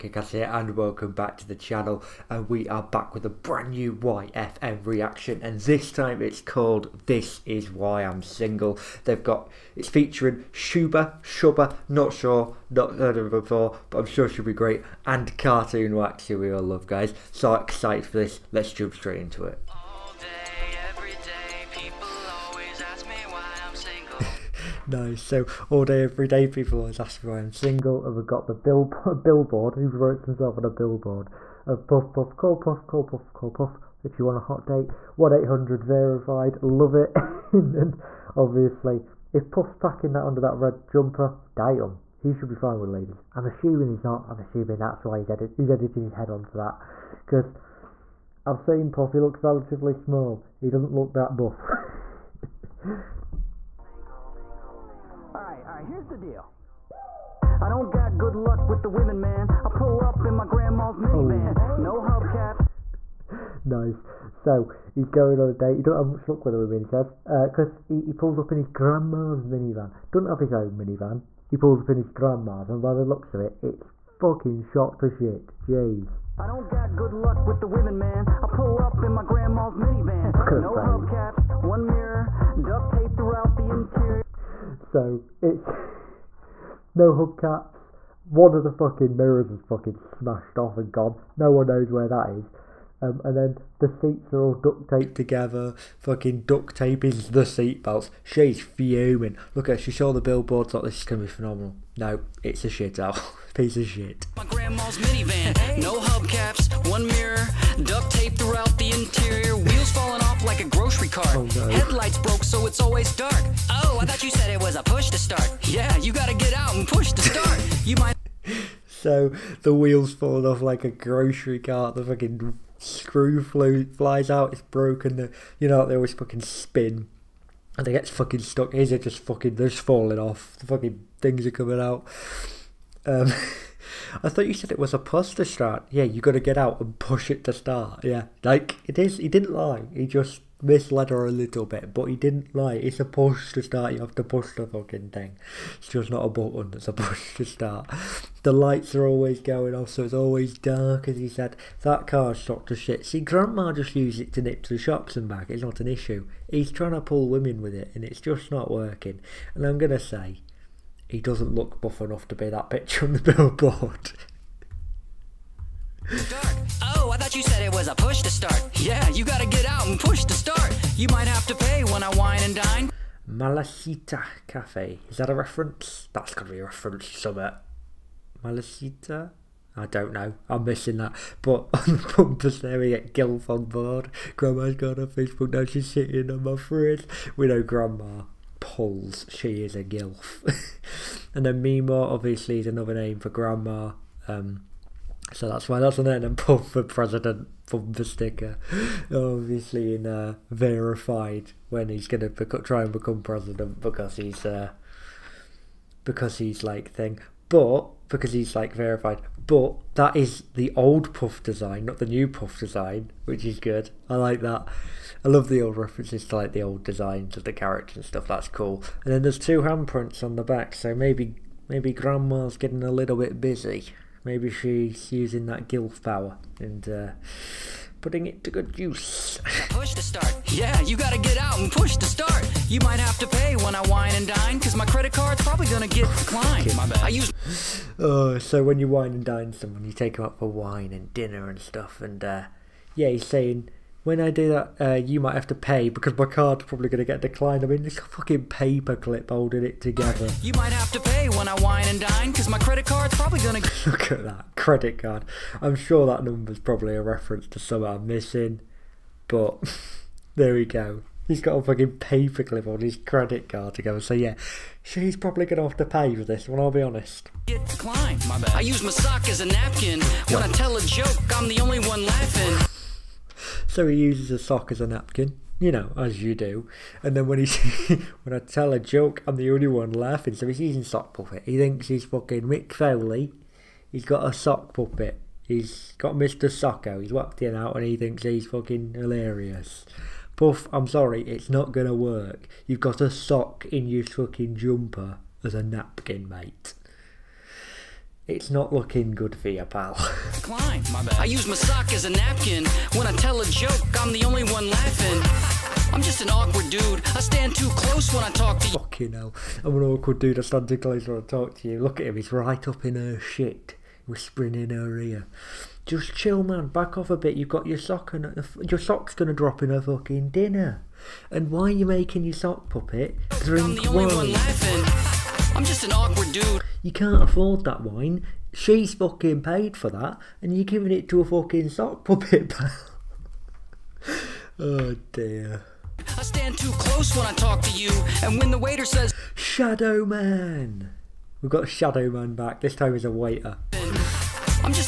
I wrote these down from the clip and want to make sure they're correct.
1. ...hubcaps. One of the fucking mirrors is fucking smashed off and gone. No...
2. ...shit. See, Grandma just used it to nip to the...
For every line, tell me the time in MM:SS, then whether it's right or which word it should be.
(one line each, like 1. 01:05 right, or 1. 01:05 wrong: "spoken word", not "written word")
1. 01:27 right
2. 02:32 right.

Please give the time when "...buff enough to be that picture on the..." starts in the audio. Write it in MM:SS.
02:41.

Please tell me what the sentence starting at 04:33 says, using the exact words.
So he uses a sock as a napkin, you know, as you do.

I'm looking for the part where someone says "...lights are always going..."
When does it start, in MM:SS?
02:28.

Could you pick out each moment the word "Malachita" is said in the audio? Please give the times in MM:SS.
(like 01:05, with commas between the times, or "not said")
02:53, 02:58.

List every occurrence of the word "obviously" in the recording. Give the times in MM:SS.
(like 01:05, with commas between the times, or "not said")
00:38, 03:12, 03:19.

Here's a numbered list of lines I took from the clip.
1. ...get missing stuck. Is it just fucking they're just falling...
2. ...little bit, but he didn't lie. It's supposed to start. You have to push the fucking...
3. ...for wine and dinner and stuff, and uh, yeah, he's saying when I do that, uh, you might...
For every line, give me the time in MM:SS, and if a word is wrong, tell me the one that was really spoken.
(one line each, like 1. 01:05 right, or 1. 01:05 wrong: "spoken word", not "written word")
1. 02:07 wrong: "fucking", not "missing"
2. 02:21 right
3. 04:00 right.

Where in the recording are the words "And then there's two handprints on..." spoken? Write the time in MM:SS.
03:39.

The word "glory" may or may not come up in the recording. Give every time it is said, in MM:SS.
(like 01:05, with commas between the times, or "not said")
not said.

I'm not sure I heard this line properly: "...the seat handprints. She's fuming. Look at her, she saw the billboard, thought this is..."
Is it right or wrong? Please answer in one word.
wrong.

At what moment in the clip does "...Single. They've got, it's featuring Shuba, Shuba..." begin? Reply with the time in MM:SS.
00:08.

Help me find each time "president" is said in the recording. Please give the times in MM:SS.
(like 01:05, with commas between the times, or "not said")
03:16, 03:23.